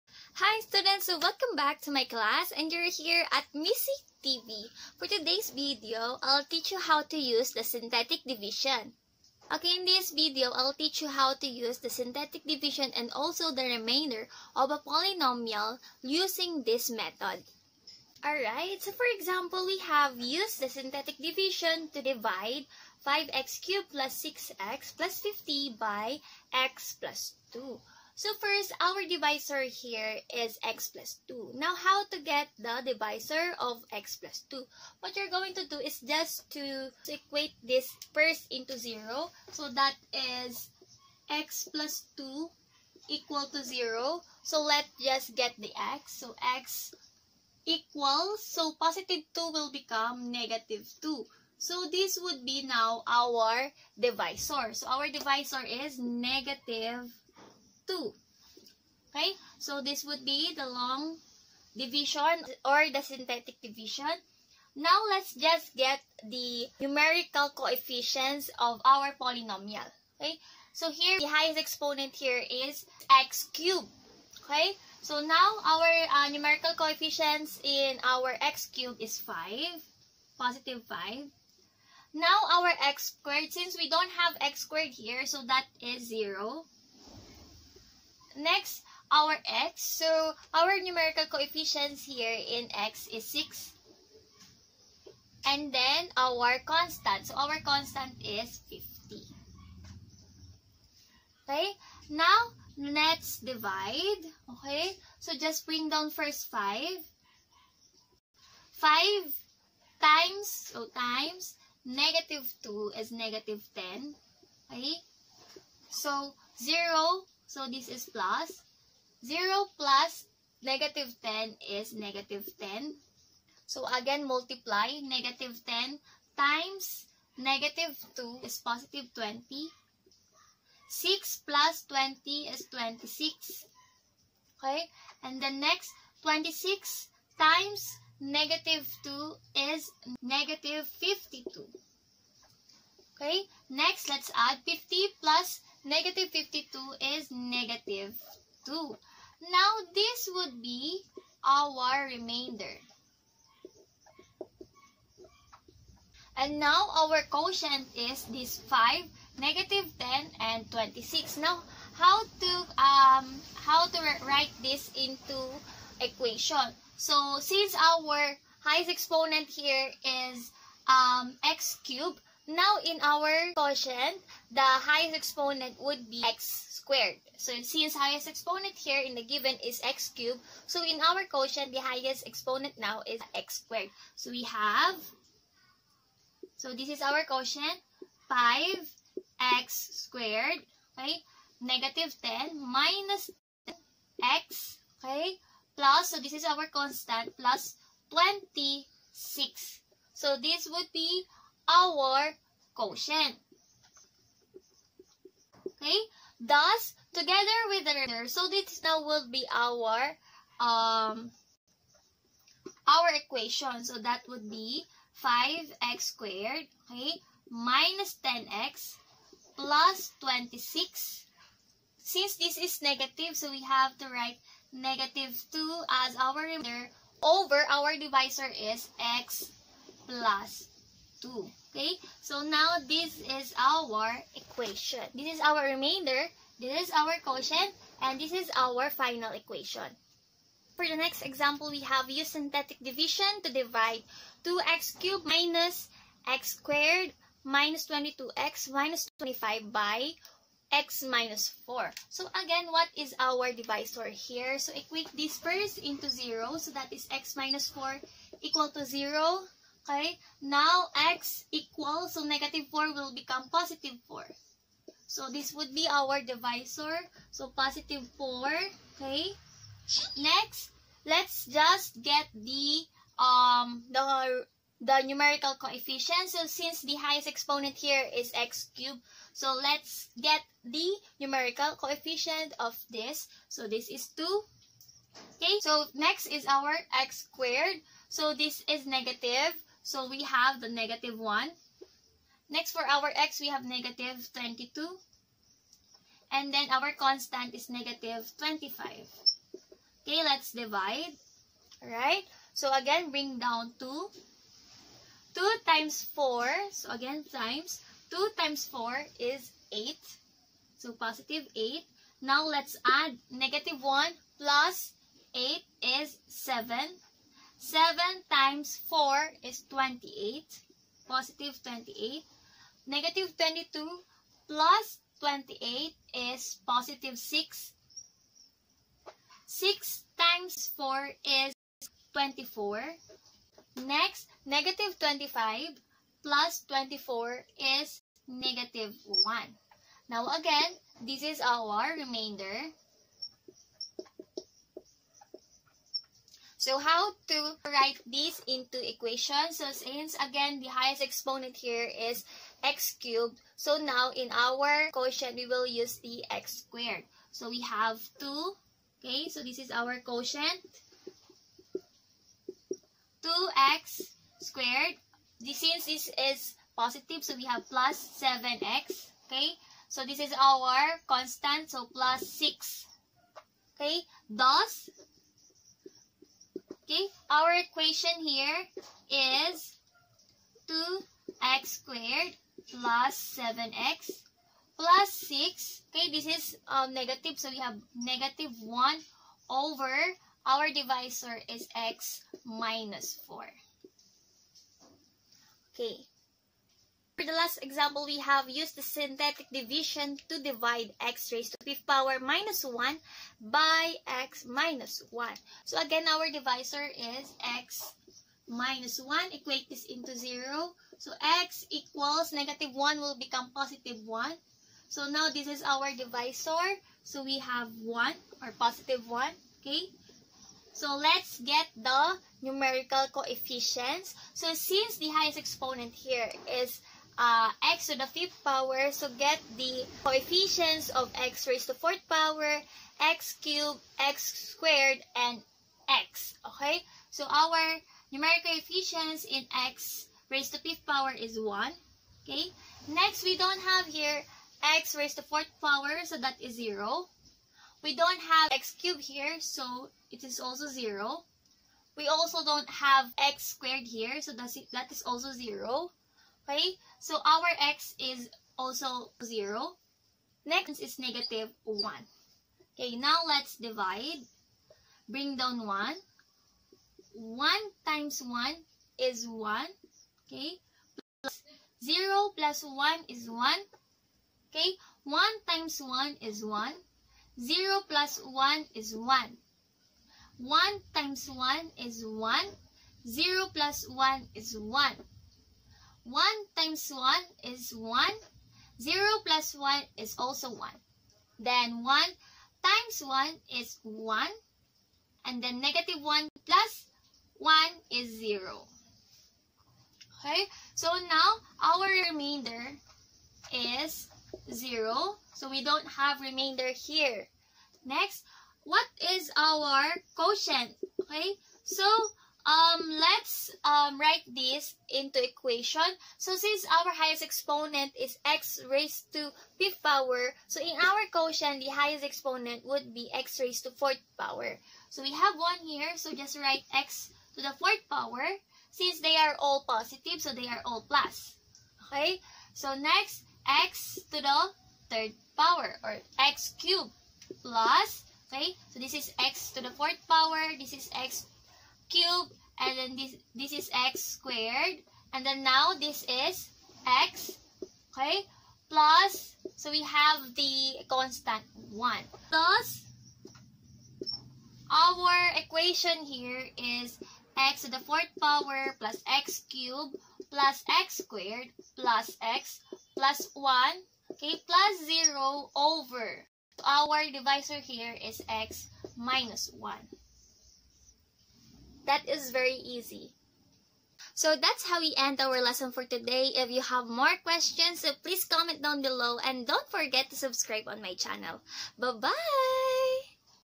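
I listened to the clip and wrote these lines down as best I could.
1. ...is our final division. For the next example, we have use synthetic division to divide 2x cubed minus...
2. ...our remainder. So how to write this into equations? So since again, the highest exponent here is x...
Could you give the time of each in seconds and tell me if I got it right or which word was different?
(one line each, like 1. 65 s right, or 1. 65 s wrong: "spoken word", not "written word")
1. 238 s wrong: "equation", not "division"
2. 341 s right.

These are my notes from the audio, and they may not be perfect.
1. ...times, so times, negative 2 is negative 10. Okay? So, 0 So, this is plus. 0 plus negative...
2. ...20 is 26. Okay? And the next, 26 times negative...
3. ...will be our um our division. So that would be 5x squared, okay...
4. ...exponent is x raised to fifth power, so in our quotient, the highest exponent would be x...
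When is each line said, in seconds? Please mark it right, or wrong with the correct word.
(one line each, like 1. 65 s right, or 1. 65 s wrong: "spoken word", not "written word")
1. 110 s right
2. 131 s right
3. 209 s wrong: "equation", not "division"
4. 517 s right.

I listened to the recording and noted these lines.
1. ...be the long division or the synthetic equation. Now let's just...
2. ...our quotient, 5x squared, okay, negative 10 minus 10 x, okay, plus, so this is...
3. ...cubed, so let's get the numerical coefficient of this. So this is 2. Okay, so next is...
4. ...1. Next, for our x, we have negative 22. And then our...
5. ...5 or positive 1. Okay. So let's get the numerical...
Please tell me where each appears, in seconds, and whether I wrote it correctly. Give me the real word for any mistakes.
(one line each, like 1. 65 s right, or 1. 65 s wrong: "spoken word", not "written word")
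1. 60 s wrong: "division", not "equation"
2. 187 s right
3. 278 s right
4. 291 s right
5. 417 s wrong: "1", not "5".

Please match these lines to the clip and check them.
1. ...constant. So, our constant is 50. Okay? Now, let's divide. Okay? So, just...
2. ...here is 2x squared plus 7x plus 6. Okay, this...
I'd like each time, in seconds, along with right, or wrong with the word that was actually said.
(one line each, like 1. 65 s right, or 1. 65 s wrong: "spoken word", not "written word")
1. 96 s right
2. 378 s right.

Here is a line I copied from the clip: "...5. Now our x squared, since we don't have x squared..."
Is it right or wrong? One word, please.
right.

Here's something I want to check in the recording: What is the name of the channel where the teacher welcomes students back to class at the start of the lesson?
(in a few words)
MsC TV.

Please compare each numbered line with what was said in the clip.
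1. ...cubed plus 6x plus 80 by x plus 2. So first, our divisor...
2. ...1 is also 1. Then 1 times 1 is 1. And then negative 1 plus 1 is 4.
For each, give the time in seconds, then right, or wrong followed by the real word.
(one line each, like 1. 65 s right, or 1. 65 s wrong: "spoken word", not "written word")
1. 23 s wrong: "50", not "80"
2. 489 s wrong: "0", not "4".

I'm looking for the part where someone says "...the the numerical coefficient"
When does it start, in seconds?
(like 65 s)
273 s.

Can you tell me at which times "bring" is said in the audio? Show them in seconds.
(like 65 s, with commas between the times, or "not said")
105 s, 303 s, 465 s.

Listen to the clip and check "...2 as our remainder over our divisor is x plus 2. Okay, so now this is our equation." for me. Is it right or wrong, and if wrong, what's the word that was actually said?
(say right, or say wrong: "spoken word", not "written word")
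right.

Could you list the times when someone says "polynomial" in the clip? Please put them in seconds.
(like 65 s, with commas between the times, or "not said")
14 s, 69 s.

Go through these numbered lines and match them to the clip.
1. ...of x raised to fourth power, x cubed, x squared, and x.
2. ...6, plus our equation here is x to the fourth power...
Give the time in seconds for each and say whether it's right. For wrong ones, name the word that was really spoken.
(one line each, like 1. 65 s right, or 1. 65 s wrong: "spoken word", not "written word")
1. 430 s right
2. 551 s wrong: "1", not "6".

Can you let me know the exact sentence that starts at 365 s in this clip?
This, since this is positive, so we have plus 7x.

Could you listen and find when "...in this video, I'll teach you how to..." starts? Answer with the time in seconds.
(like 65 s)
9 s.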